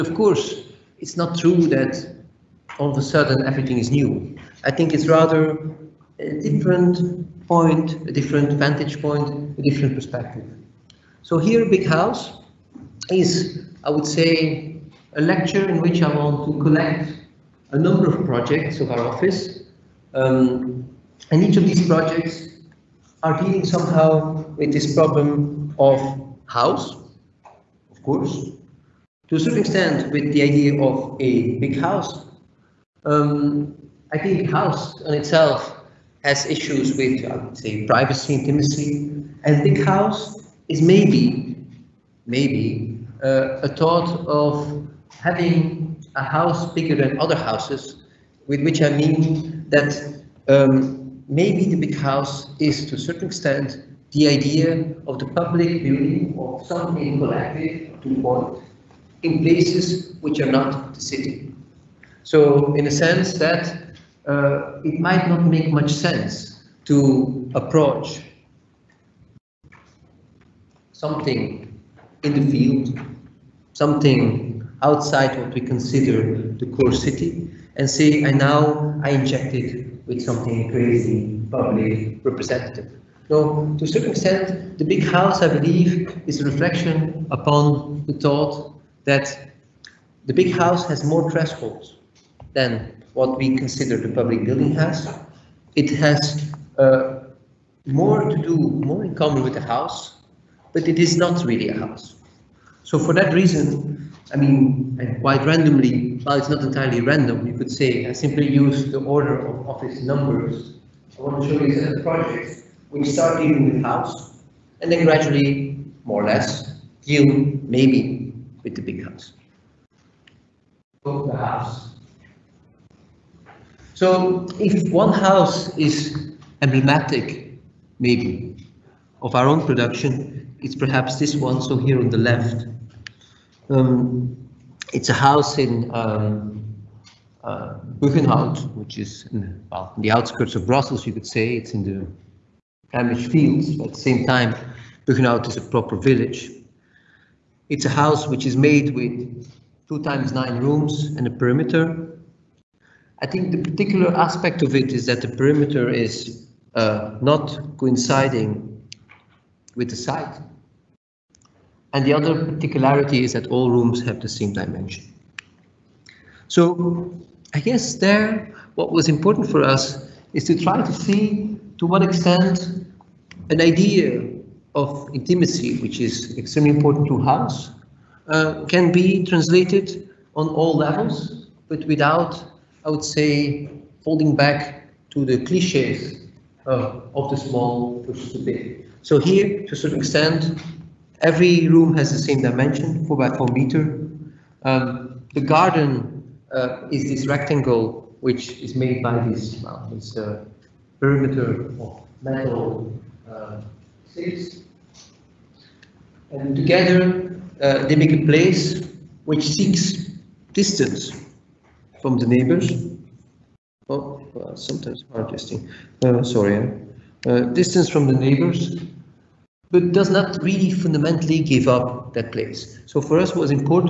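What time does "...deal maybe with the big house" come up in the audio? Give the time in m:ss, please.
1:57.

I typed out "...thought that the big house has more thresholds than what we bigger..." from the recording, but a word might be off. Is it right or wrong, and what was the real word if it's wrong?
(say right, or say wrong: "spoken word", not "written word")
wrong: "consider", not "bigger".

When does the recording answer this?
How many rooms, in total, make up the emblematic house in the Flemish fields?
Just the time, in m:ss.
2:29.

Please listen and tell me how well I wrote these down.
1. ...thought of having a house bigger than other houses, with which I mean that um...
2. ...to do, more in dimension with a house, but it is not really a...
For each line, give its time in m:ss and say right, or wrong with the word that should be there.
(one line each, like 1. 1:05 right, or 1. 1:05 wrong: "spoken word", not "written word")
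1. 0:43 right
2. 1:38 wrong: "common", not "dimension".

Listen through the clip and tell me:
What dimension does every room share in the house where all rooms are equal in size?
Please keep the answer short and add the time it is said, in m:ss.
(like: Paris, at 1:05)
4 by 4 meters, at 3:13.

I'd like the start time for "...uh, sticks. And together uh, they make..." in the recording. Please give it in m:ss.
3:23.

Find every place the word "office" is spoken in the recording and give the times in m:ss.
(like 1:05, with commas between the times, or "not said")
0:19, 1:49.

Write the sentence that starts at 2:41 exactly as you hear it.
And the other particularity is that all rooms have the same dimension.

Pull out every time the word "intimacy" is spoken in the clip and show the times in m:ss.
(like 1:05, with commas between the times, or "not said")
0:38, 2:55.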